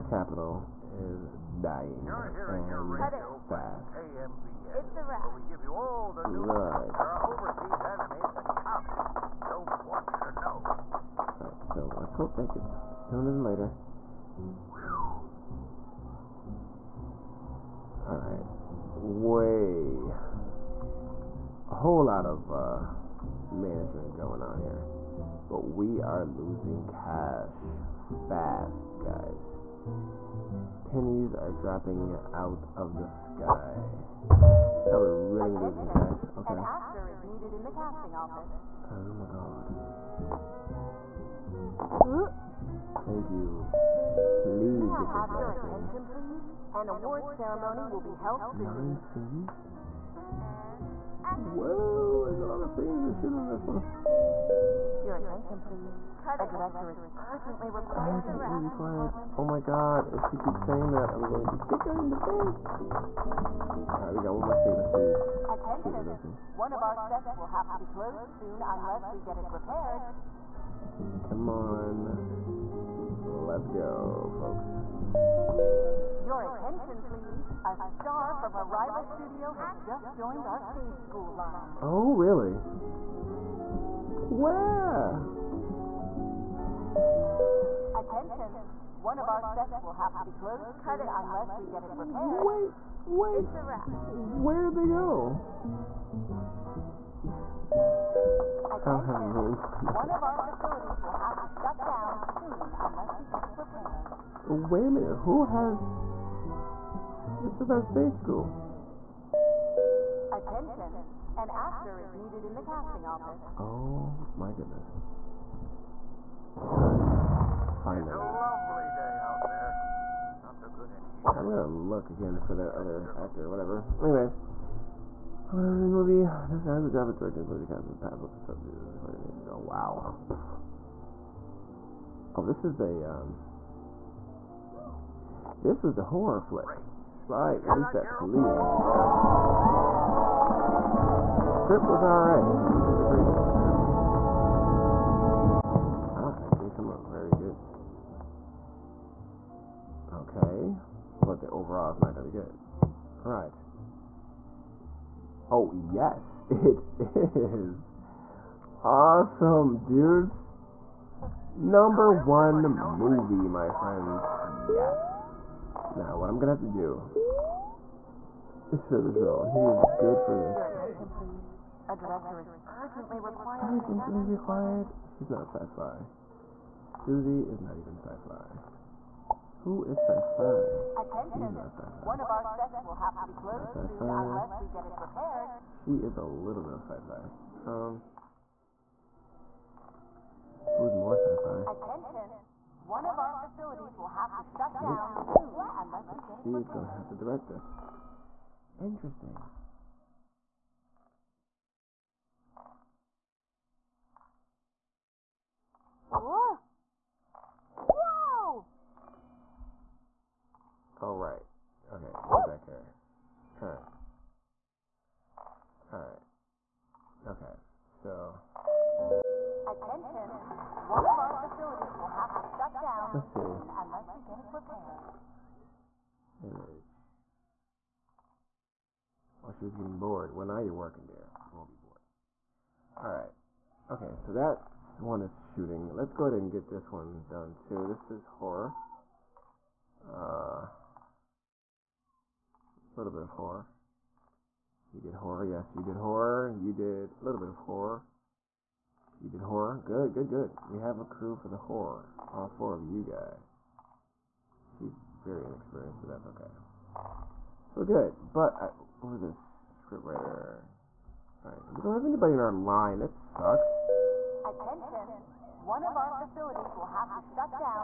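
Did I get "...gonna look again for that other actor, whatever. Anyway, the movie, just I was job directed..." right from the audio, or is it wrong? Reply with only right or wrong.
right.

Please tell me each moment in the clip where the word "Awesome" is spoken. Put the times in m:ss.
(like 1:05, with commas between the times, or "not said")
2:38.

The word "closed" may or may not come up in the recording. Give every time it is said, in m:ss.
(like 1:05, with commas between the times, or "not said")
1:07, 1:30, 3:03.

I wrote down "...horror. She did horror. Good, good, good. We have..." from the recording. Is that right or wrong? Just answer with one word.
right.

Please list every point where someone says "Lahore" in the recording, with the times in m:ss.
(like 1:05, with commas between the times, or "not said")
not said.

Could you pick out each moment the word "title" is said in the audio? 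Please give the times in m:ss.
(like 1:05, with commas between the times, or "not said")
not said.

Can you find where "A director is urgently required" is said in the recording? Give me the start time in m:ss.
0:56.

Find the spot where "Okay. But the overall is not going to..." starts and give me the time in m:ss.
2:30.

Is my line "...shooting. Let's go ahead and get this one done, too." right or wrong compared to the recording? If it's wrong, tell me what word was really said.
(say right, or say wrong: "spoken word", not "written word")
right.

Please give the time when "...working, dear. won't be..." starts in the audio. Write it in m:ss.
3:50.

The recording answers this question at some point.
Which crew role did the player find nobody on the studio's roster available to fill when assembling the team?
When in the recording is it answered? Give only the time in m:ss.
4:19.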